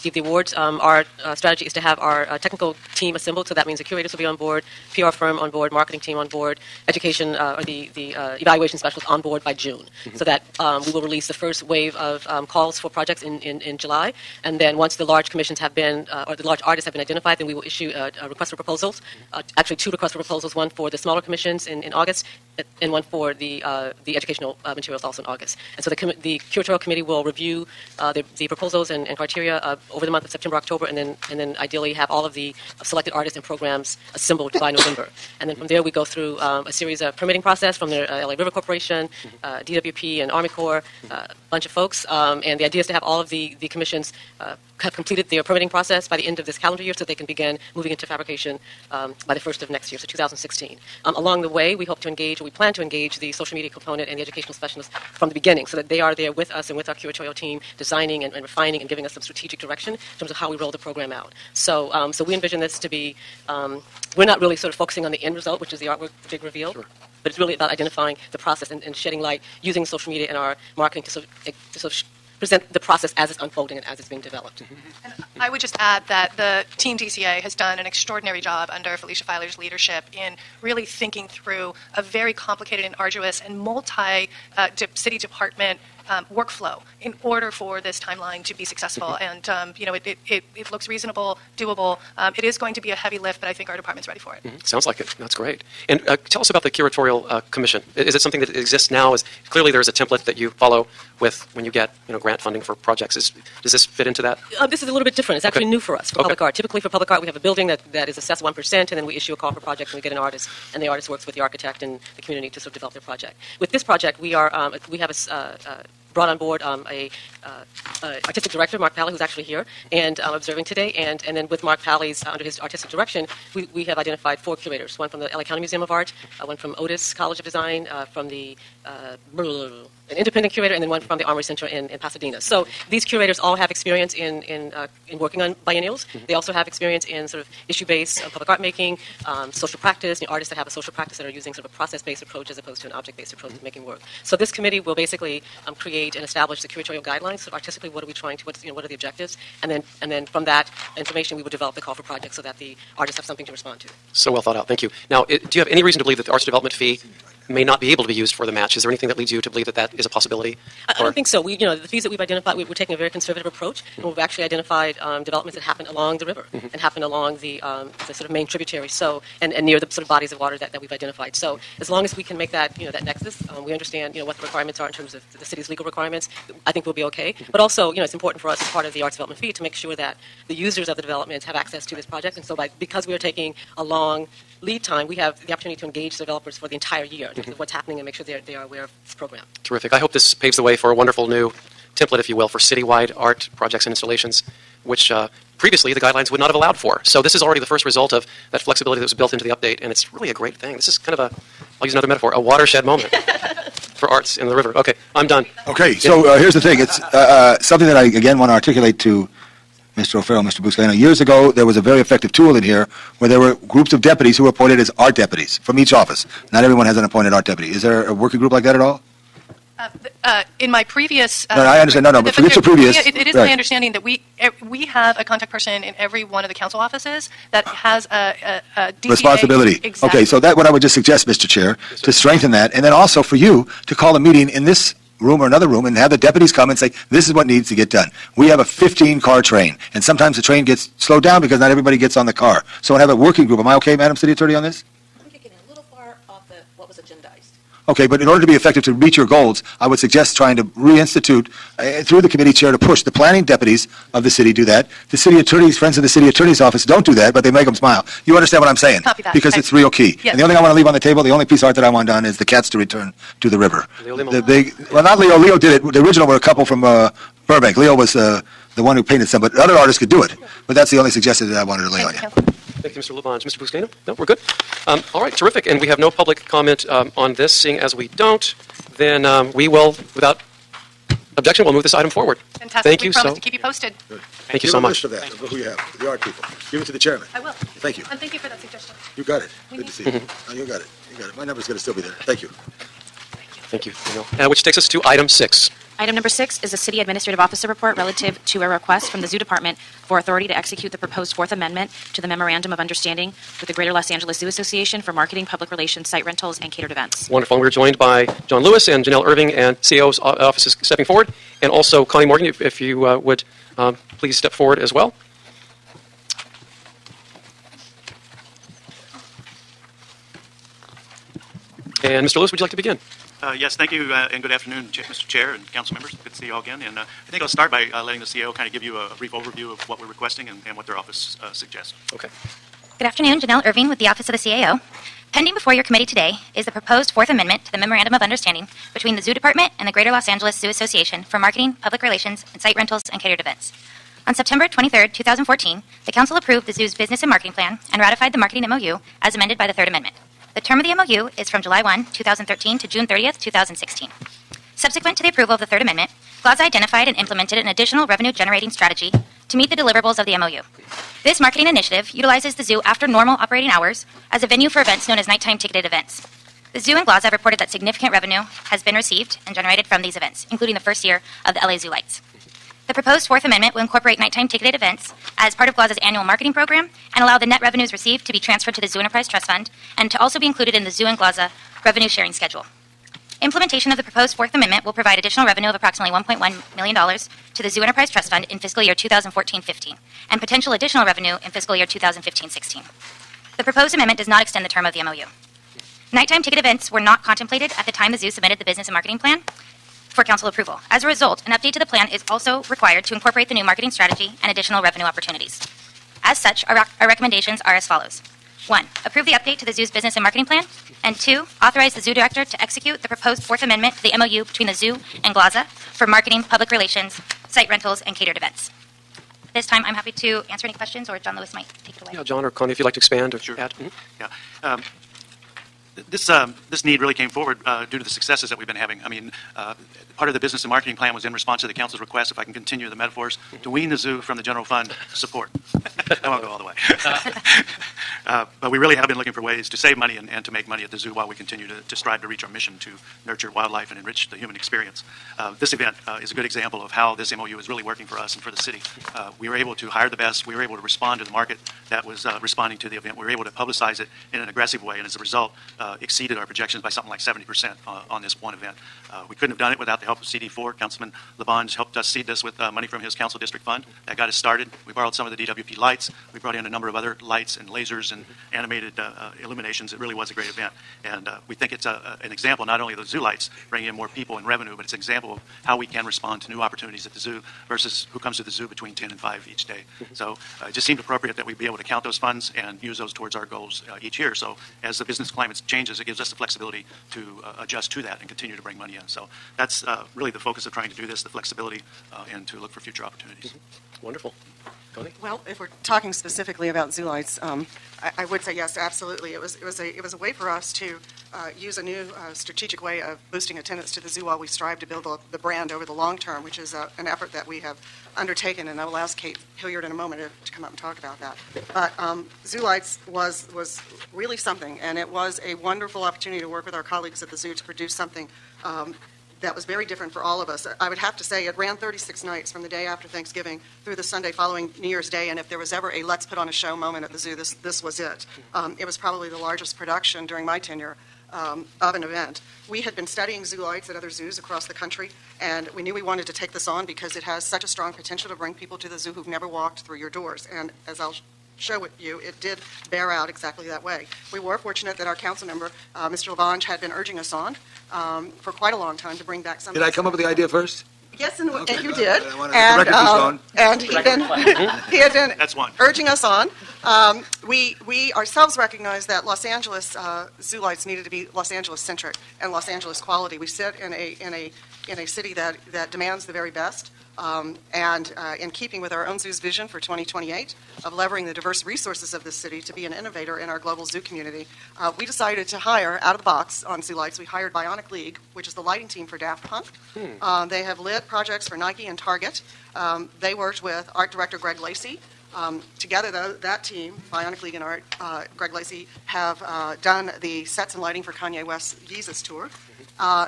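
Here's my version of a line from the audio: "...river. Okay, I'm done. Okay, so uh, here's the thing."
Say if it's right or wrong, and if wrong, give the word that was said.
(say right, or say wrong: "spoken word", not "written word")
right.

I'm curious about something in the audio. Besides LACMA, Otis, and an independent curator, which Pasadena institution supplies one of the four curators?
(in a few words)
Armory Center.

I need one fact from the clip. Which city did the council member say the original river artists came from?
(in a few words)
Burbank.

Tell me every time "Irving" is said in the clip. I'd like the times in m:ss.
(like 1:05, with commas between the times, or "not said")
5:09, 5:33.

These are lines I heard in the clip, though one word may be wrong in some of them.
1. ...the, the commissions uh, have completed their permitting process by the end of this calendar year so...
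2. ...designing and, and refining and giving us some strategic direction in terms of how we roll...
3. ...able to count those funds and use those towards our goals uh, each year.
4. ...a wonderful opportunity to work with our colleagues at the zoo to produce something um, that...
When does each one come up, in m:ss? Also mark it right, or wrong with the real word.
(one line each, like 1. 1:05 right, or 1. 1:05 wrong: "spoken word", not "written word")
1. 0:43 right
2. 0:57 right
3. 8:01 right
4. 8:35 right.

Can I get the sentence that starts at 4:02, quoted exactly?
So I have a working group.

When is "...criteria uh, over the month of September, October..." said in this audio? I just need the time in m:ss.
0:29.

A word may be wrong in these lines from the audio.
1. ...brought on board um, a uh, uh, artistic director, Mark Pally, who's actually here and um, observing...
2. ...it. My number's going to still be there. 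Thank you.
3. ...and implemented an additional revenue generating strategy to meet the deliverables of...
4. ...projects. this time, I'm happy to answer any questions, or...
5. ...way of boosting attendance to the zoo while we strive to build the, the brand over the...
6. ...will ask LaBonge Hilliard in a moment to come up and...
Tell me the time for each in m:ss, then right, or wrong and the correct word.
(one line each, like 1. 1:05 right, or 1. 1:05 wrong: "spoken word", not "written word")
1. 1:56 right
2. 4:51 right
3. 5:57 right
4. 6:58 wrong: "events", not "projects"
5. 8:22 right
6. 8:28 wrong: "Kate", not "LaBonge".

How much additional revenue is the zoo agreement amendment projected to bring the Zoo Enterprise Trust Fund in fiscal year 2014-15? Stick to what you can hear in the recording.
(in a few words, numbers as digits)
$1.1 million.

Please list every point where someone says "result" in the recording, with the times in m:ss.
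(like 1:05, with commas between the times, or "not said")
1:05, 3:17, 6:41, 7:35.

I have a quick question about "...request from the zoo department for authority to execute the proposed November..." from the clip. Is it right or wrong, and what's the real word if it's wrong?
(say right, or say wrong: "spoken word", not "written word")
wrong: "Fourth", not "November".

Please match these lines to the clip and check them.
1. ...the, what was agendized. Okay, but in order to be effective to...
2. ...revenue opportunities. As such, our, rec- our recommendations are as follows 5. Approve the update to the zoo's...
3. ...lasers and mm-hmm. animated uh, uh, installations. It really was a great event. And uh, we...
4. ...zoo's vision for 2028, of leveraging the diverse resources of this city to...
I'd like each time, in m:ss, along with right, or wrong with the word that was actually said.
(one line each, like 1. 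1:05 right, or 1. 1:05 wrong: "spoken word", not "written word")
1. 4:06 right
2. 6:44 wrong: "1", not "5"
3. 7:47 wrong: "illuminations", not "installations"
4. 9:29 right.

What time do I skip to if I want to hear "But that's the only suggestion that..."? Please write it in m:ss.
4:30.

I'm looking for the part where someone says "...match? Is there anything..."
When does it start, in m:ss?
2:38.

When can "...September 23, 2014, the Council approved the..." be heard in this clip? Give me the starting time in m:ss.
5:44.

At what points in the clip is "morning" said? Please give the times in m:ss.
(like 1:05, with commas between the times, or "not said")
not said.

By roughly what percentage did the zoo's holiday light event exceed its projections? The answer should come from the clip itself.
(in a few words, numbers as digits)
70%.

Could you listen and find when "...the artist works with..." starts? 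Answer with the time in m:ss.
1:50.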